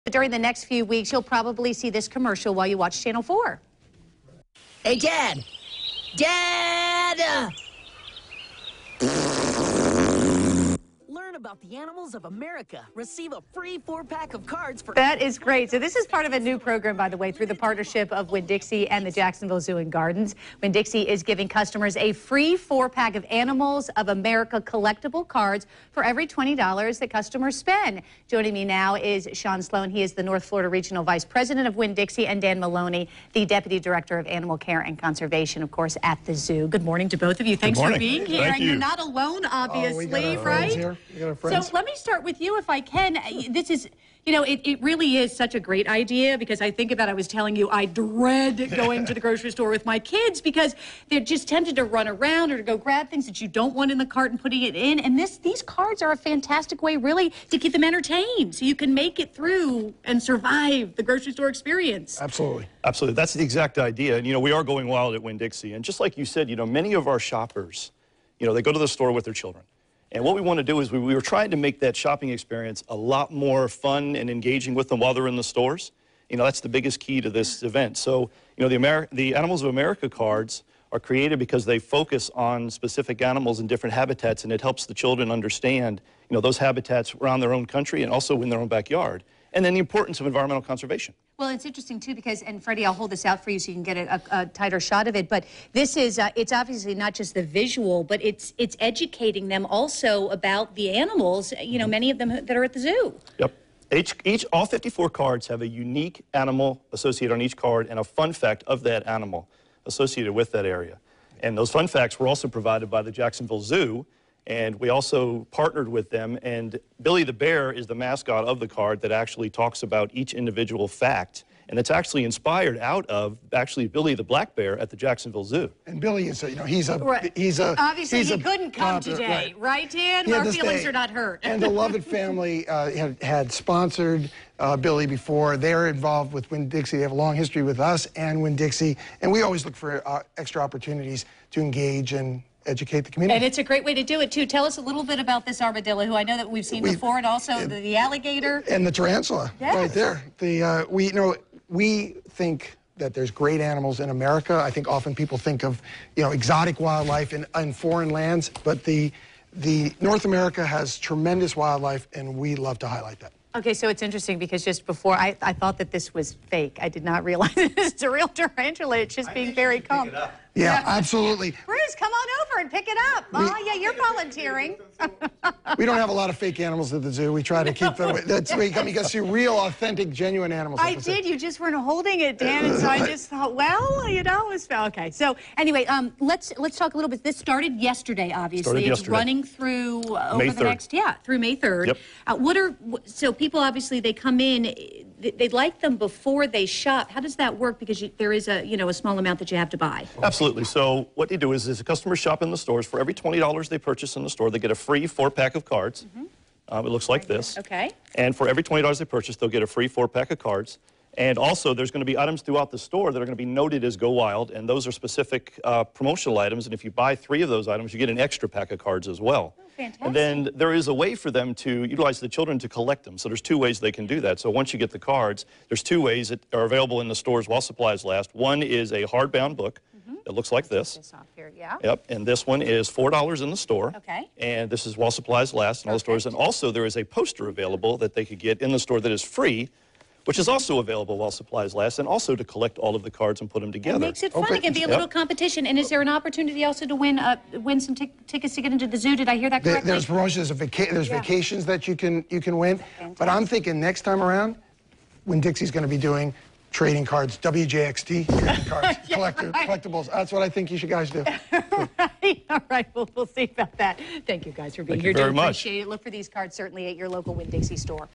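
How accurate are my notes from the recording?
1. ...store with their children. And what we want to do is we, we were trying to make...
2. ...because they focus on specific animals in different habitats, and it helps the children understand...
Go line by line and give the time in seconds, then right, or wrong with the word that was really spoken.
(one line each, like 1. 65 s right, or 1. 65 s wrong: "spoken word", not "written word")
1. 68 s right
2. 81 s right.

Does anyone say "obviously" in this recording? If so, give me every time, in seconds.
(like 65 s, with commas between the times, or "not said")
39 s, 96 s, 127 s, 188 s, 193 s.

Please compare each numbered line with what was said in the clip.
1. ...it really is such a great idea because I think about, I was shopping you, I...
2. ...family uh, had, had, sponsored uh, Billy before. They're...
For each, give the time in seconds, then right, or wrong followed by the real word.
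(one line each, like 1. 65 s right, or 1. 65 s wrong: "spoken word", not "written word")
1. 44 s wrong: "telling", not "shopping"
2. 132 s right.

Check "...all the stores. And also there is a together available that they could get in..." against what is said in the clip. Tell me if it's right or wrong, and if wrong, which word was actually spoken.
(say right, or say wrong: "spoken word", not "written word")
wrong: "poster", not "together".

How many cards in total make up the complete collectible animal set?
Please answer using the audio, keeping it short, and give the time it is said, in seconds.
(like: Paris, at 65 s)
54, at 104 s.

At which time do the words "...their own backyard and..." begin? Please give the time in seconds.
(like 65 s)
88 s.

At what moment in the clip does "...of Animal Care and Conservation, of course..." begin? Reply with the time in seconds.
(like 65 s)
34 s.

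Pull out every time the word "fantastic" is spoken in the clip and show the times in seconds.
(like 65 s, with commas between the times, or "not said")
56 s, 219 s.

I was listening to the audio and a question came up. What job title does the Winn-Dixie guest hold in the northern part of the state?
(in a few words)
North Florida Regional Vice President.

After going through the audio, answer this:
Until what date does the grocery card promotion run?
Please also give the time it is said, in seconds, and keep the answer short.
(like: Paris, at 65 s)
May 3rd, at 191 s.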